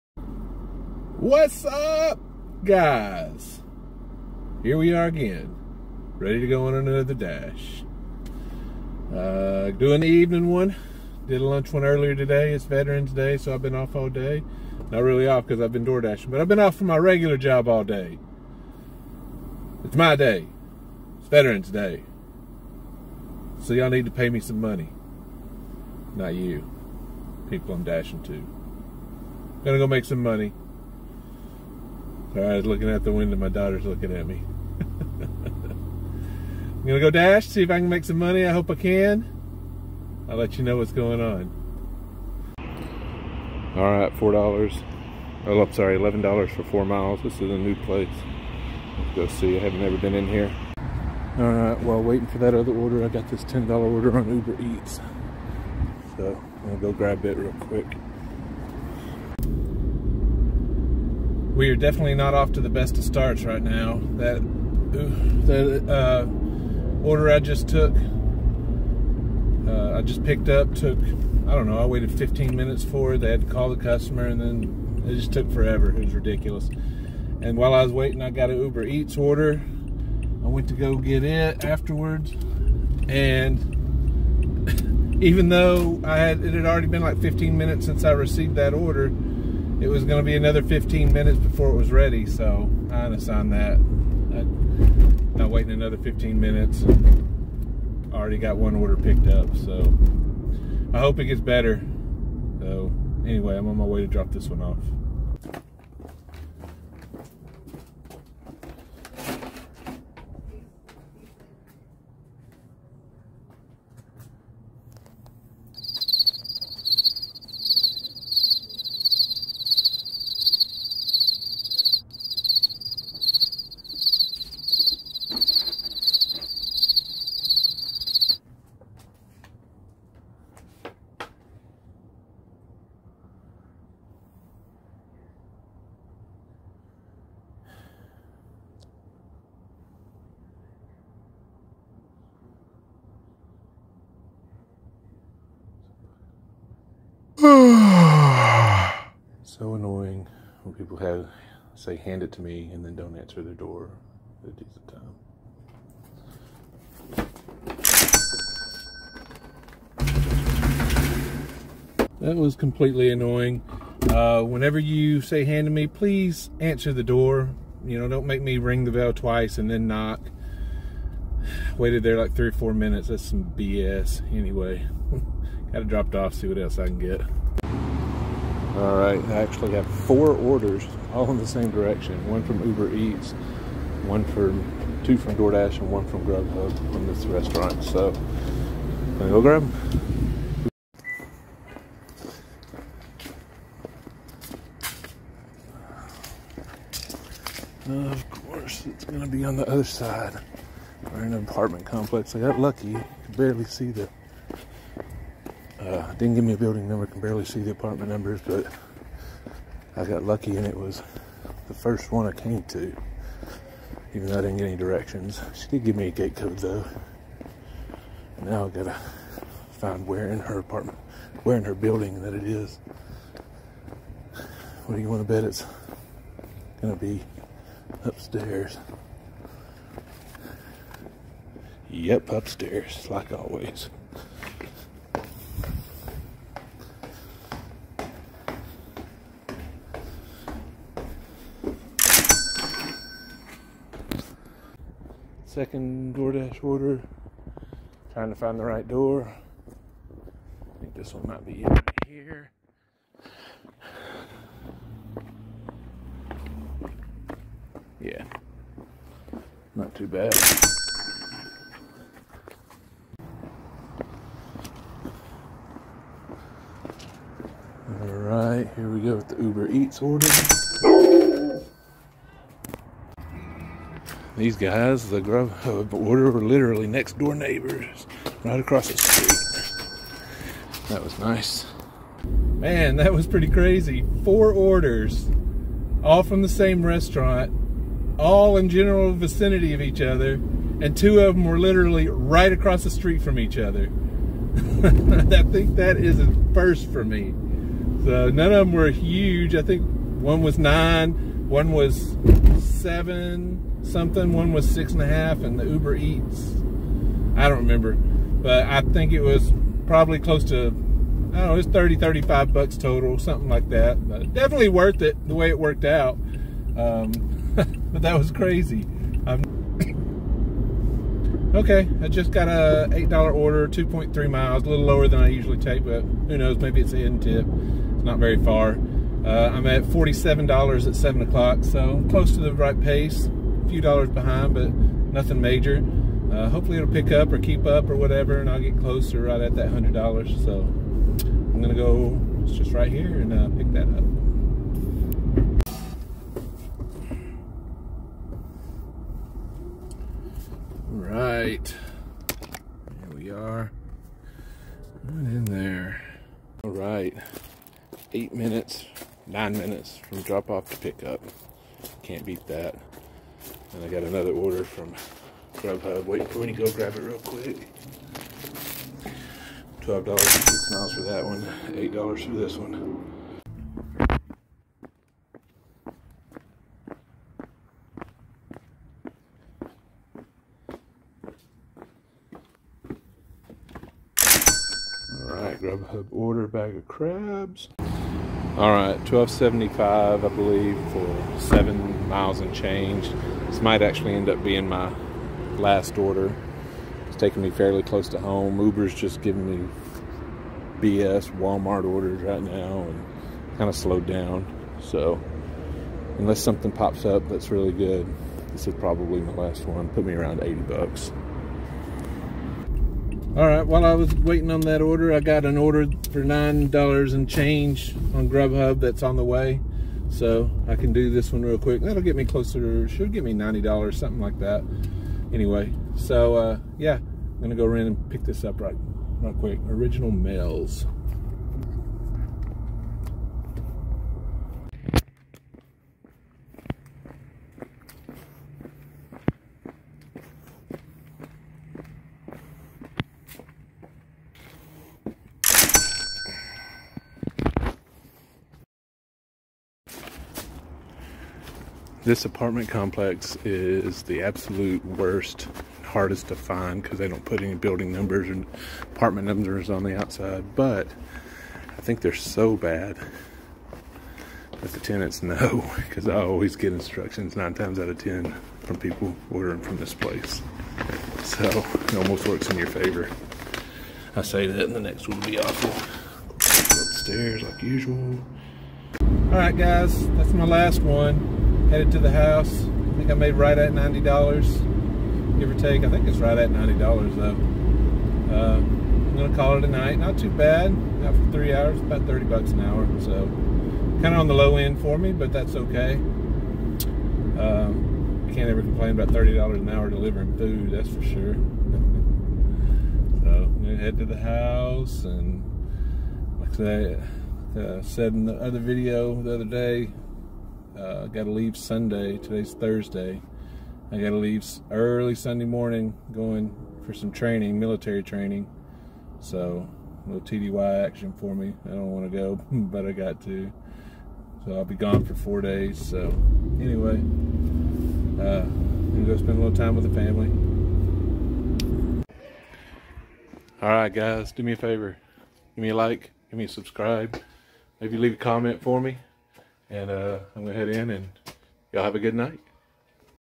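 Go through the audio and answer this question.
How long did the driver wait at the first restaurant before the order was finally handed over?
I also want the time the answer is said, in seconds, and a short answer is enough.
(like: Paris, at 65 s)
15 minutes, at 71 s.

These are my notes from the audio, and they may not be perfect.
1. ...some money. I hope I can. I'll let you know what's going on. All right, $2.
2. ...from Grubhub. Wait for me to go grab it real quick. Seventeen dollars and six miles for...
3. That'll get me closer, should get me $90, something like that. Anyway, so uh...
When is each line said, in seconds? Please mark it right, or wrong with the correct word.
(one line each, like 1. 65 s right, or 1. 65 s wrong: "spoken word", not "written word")
1. 38 s wrong: "4", not "2"
2. 364 s wrong: "Twelve", not "Seventeen"
3. 421 s right.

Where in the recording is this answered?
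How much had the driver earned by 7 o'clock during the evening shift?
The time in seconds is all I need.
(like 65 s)
329 s.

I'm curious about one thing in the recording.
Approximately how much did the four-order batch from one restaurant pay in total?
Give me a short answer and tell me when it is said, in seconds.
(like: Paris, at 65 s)
35 dollars, at 311 s.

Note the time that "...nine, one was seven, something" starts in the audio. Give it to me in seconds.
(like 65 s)
300 s.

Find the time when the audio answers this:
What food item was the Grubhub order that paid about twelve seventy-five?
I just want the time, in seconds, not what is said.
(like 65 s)
386 s.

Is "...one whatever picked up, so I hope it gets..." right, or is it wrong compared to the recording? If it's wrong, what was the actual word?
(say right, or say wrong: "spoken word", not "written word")
wrong: "order", not "whatever".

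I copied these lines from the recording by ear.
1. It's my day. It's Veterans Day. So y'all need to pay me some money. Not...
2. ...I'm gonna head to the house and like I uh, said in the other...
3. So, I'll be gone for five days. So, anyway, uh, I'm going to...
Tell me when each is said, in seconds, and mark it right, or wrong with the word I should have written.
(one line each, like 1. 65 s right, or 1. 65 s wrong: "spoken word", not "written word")
1. 19 s right
2. 503 s right
3. 524 s wrong: "four", not "five".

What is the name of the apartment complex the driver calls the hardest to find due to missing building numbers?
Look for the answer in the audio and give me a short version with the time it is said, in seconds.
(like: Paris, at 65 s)
Original Mills, at 429 s.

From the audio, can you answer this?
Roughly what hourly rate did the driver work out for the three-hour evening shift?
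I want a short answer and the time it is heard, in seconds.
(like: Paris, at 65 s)
$30 an hour, at 492 s.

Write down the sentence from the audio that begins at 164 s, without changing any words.
Uh, whenever you say hand to me, please answer the door.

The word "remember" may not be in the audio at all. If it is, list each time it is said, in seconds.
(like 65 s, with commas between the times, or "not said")
307 s.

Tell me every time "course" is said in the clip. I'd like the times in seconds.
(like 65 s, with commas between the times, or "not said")
198 s.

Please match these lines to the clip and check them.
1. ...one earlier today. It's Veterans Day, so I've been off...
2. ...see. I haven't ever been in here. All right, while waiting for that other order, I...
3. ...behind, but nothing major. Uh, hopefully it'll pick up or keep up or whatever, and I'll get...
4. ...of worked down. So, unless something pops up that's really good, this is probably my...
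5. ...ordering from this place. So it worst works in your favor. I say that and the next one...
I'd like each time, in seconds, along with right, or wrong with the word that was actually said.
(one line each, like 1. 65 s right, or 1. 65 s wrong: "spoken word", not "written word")
1. 11 s right
2. 49 s right
3. 334 s right
4. 403 s wrong: "slowed", not "worked"
5. 469 s wrong: "almost", not "worst".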